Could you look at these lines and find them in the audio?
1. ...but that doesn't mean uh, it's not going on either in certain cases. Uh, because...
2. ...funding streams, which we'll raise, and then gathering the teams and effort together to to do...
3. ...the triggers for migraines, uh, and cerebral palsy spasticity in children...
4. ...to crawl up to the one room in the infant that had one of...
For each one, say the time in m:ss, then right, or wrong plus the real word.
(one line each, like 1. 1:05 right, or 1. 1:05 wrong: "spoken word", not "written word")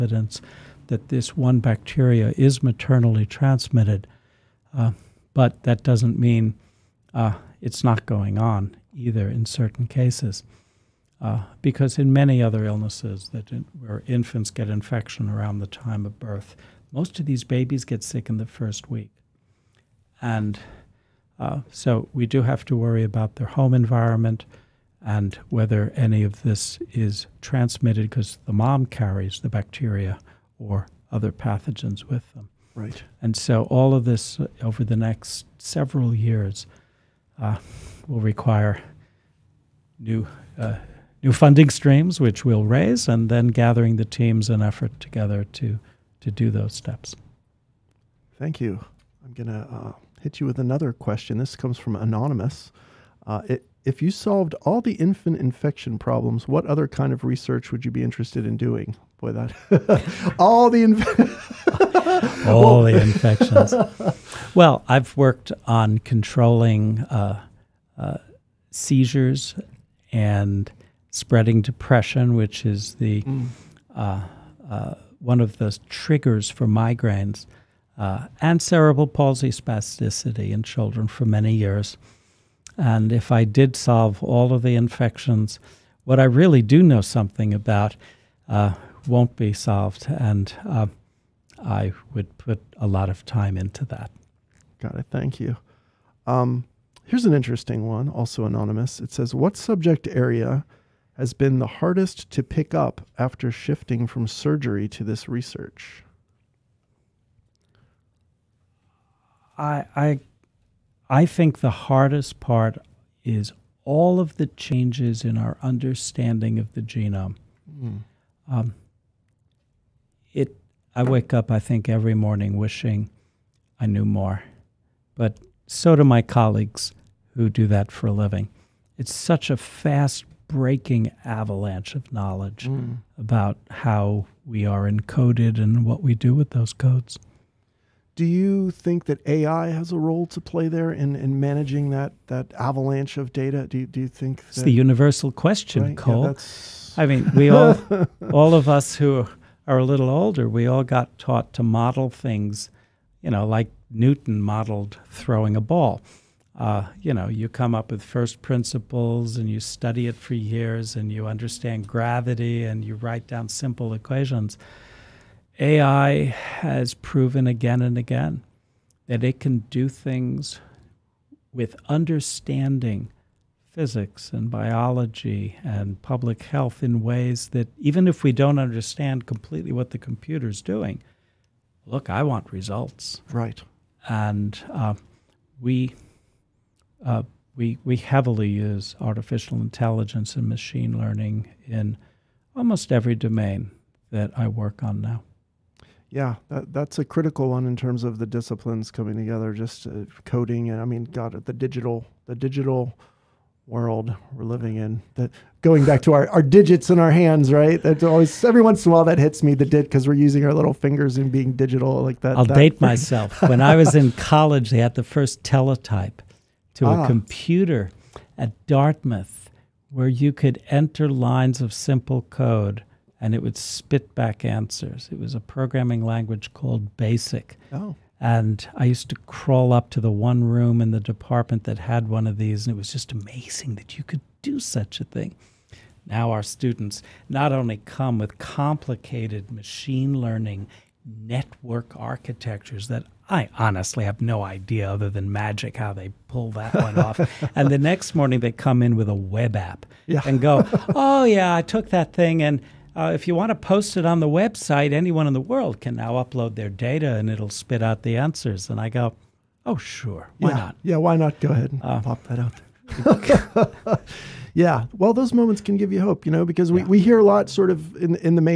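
1. 0:05 right
2. 0:41 right
3. 1:15 right
4. 3:49 wrong: "department", not "infant".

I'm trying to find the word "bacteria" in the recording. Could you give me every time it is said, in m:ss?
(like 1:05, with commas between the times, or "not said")
0:01, 0:29.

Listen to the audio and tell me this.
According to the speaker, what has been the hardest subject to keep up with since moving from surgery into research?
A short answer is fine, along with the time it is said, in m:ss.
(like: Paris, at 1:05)
The genome, at 1:56.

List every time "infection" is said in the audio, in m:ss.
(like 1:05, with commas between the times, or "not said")
0:14, 0:55, 1:03, 1:24.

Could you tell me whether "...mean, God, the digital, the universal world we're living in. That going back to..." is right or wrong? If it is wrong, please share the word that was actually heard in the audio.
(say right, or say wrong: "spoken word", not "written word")
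wrong: "digital", not "universal".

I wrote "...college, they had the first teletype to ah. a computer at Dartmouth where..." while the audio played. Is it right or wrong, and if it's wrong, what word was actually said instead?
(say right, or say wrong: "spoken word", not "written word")
right.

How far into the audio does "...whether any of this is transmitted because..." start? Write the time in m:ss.
0:25.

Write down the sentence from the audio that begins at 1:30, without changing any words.
And uh, I would put a lot of time into that.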